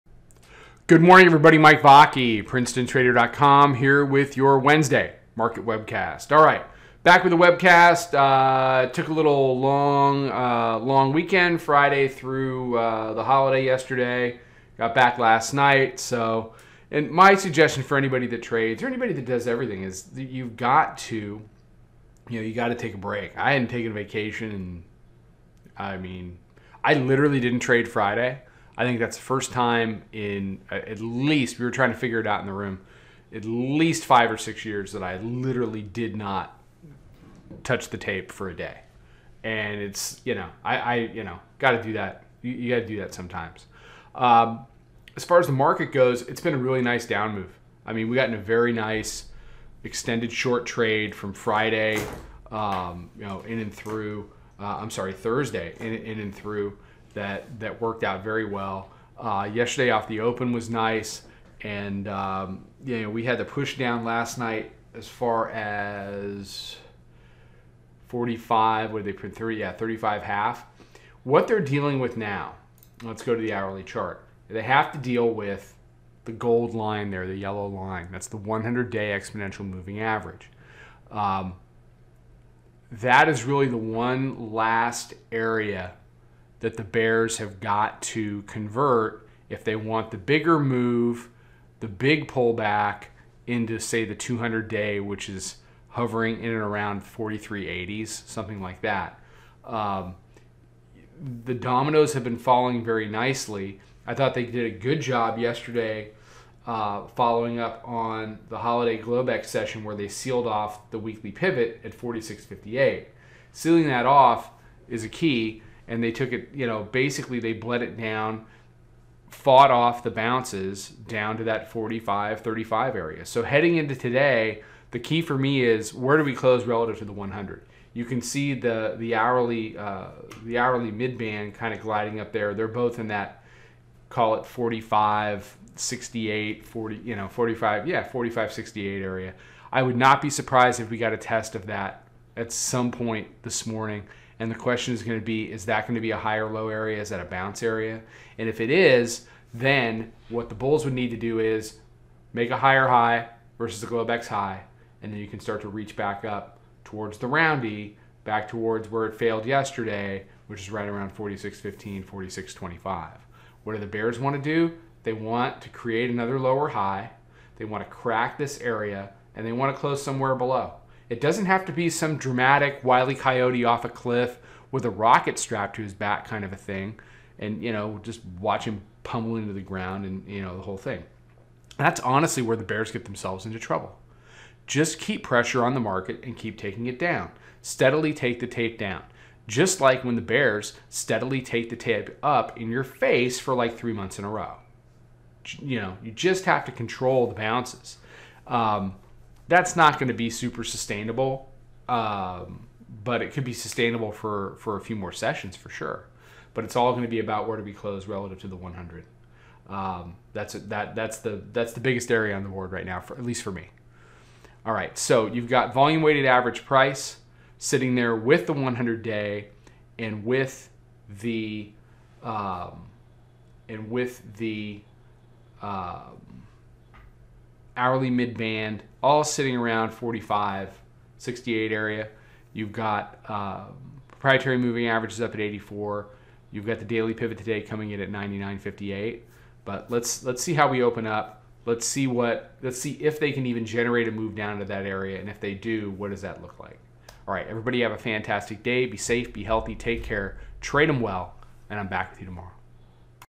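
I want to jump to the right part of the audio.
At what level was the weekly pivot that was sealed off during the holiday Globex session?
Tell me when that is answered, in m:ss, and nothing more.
1:51.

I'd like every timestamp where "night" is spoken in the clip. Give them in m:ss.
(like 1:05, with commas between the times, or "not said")
0:15, 1:04.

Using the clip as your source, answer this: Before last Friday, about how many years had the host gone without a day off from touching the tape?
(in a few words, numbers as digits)
5 or 6 years.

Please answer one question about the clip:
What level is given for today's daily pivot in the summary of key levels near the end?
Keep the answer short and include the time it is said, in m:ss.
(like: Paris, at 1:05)
99.58, at 3:58.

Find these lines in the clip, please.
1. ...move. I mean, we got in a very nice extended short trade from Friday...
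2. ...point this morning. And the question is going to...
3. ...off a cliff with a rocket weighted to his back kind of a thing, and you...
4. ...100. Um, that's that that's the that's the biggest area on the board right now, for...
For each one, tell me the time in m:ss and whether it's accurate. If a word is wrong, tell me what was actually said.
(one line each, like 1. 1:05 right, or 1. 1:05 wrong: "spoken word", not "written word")
1. 0:47 right
2. 2:22 right
3. 2:53 wrong: "strapped", not "weighted"
4. 3:28 right.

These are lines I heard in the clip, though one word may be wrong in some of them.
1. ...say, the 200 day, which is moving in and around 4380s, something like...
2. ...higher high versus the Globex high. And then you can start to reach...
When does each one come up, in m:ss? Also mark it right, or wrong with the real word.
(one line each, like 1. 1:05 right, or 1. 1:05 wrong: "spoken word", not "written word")
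1. 1:33 wrong: "hovering", not "moving"
2. 2:32 right.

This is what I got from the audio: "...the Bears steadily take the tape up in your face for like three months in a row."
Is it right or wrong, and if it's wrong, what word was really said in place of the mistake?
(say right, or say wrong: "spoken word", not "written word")
right.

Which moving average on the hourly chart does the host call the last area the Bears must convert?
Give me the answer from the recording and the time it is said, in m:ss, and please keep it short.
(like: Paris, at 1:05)
100-day exponential moving average, at 1:18.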